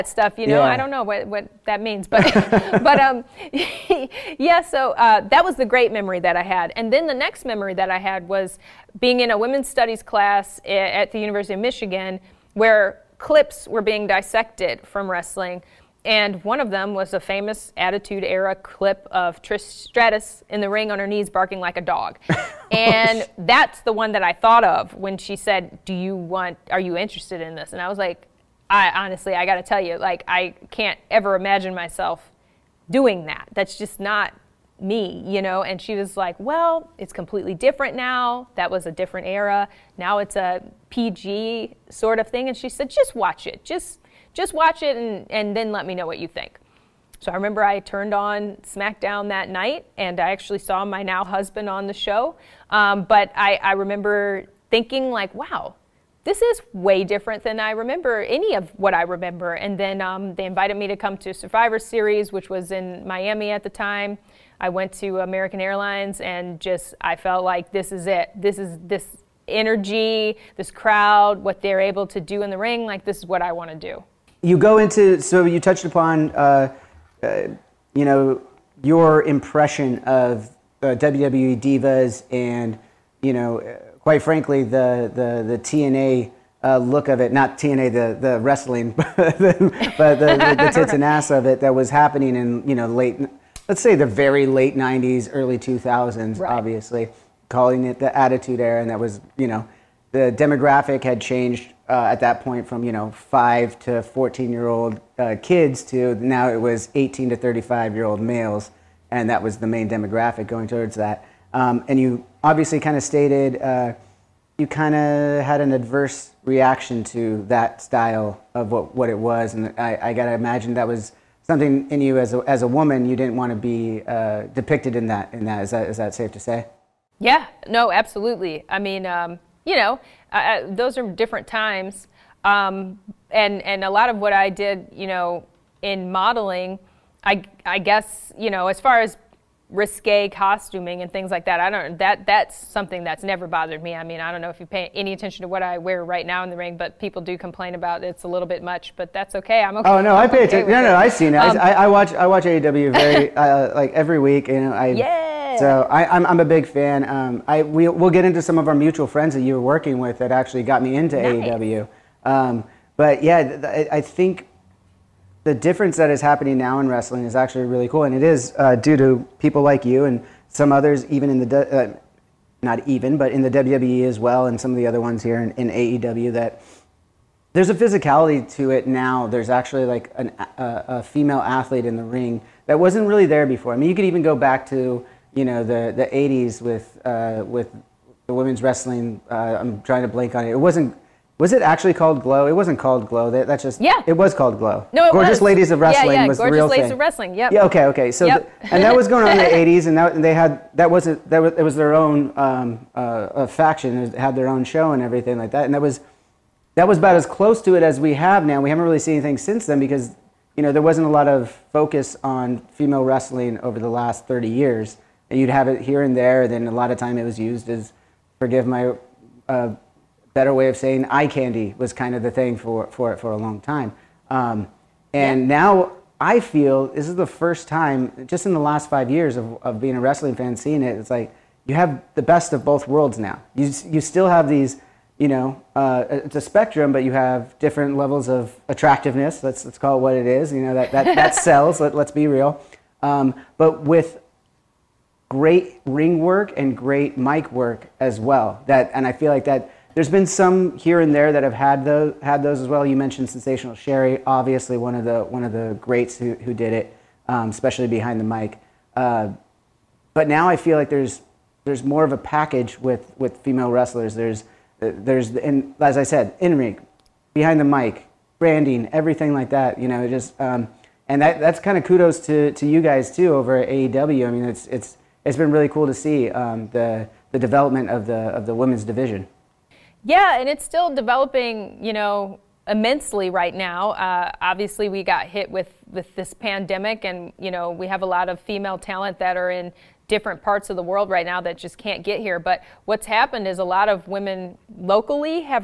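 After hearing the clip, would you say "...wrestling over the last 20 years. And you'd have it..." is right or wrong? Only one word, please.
wrong.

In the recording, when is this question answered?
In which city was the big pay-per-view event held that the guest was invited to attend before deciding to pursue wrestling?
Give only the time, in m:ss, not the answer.
1:03.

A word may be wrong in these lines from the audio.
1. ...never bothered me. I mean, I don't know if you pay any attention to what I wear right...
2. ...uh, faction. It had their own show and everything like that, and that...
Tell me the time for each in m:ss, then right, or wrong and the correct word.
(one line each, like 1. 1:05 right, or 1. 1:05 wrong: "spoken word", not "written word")
1. 2:23 right
2. 3:22 right.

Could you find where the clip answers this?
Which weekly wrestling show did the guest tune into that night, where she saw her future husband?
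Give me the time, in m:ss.
0:48.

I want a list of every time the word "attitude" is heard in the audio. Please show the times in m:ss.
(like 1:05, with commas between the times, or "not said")
0:17, 1:38.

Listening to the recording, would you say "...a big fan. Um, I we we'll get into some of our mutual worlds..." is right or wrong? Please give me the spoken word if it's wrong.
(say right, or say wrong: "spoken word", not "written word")
wrong: "friends", not "worlds".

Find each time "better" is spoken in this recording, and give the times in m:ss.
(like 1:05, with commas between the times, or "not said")
3:40.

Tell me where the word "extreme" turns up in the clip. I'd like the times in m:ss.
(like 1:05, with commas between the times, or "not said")
not said.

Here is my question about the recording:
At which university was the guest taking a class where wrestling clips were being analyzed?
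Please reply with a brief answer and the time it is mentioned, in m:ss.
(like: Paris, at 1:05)
University of Michigan, at 0:11.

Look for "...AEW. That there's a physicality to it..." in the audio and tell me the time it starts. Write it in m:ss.
2:56.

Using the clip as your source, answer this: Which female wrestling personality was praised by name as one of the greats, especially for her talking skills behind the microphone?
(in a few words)
Sensational Sherri.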